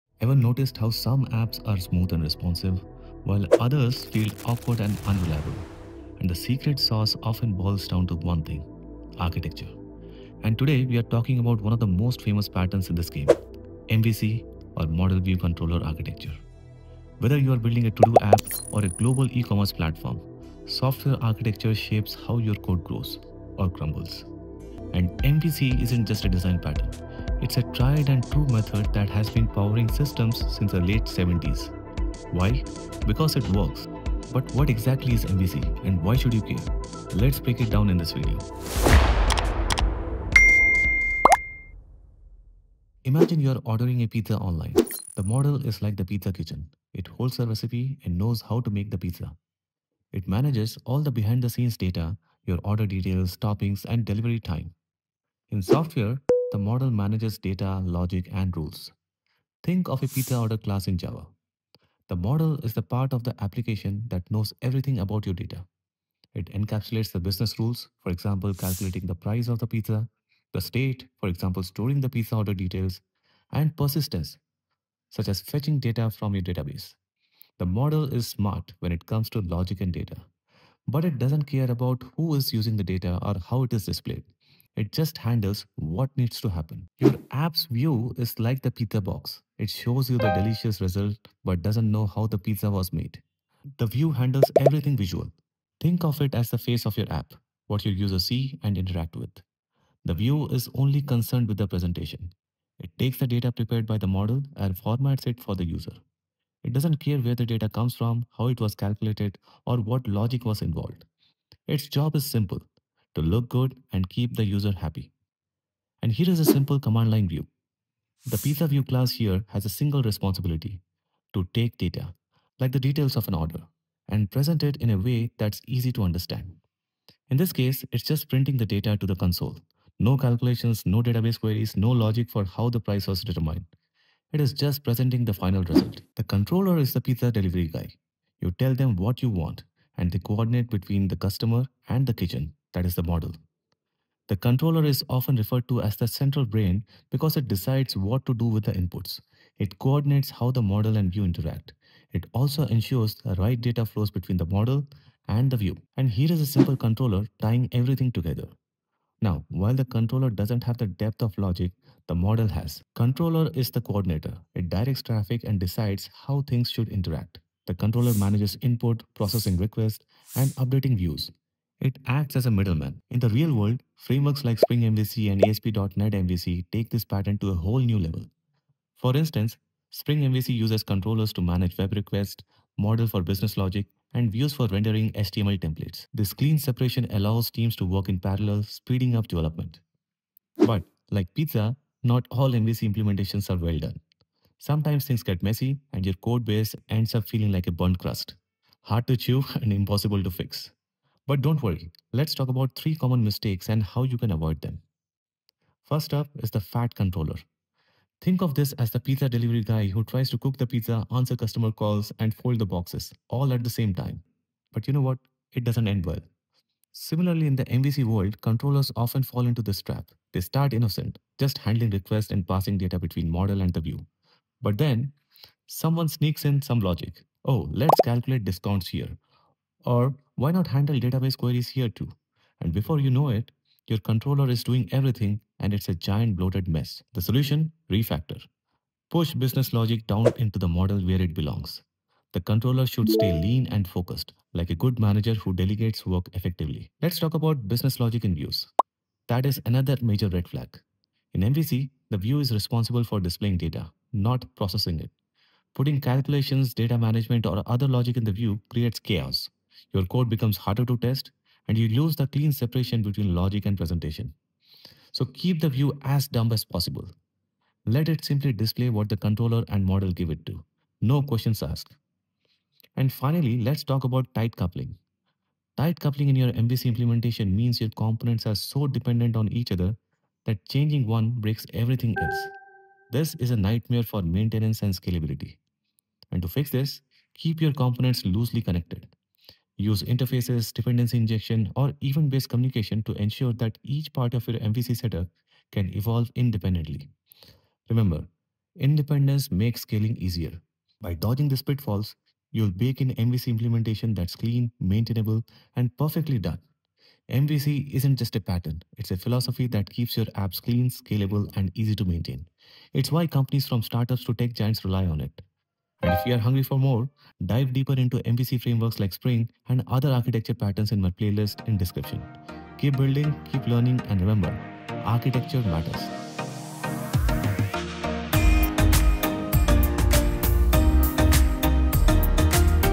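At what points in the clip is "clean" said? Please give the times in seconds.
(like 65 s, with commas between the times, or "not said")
186 s, 262 s, 304 s, 310 s.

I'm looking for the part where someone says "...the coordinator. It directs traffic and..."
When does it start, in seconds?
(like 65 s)
163 s.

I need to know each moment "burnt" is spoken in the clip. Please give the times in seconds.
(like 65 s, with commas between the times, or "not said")
197 s.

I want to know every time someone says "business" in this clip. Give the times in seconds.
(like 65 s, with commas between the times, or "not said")
67 s, 183 s, 239 s, 247 s.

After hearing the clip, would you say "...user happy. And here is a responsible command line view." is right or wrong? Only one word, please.
wrong.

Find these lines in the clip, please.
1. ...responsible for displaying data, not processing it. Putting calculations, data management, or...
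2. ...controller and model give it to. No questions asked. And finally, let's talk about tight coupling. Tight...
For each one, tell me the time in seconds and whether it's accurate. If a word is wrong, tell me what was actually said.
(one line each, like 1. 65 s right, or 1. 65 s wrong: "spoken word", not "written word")
1. 252 s right
2. 269 s right.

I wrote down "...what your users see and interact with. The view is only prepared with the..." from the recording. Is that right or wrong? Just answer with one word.
wrong.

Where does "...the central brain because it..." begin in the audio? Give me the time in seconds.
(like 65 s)
145 s.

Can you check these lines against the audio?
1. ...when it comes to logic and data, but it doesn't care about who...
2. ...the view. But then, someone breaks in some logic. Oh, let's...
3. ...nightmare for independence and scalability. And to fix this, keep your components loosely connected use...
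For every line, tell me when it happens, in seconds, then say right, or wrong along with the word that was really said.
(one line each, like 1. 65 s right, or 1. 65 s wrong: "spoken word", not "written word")
1. 78 s right
2. 223 s wrong: "sneaks", not "breaks"
3. 283 s wrong: "maintenance", not "independence".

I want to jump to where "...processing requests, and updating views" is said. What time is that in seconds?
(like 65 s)
169 s.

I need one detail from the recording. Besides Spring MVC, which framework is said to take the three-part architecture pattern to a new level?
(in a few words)
ASP.NET MVC.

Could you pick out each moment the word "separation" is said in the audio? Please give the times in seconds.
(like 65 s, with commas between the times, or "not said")
186 s, 262 s.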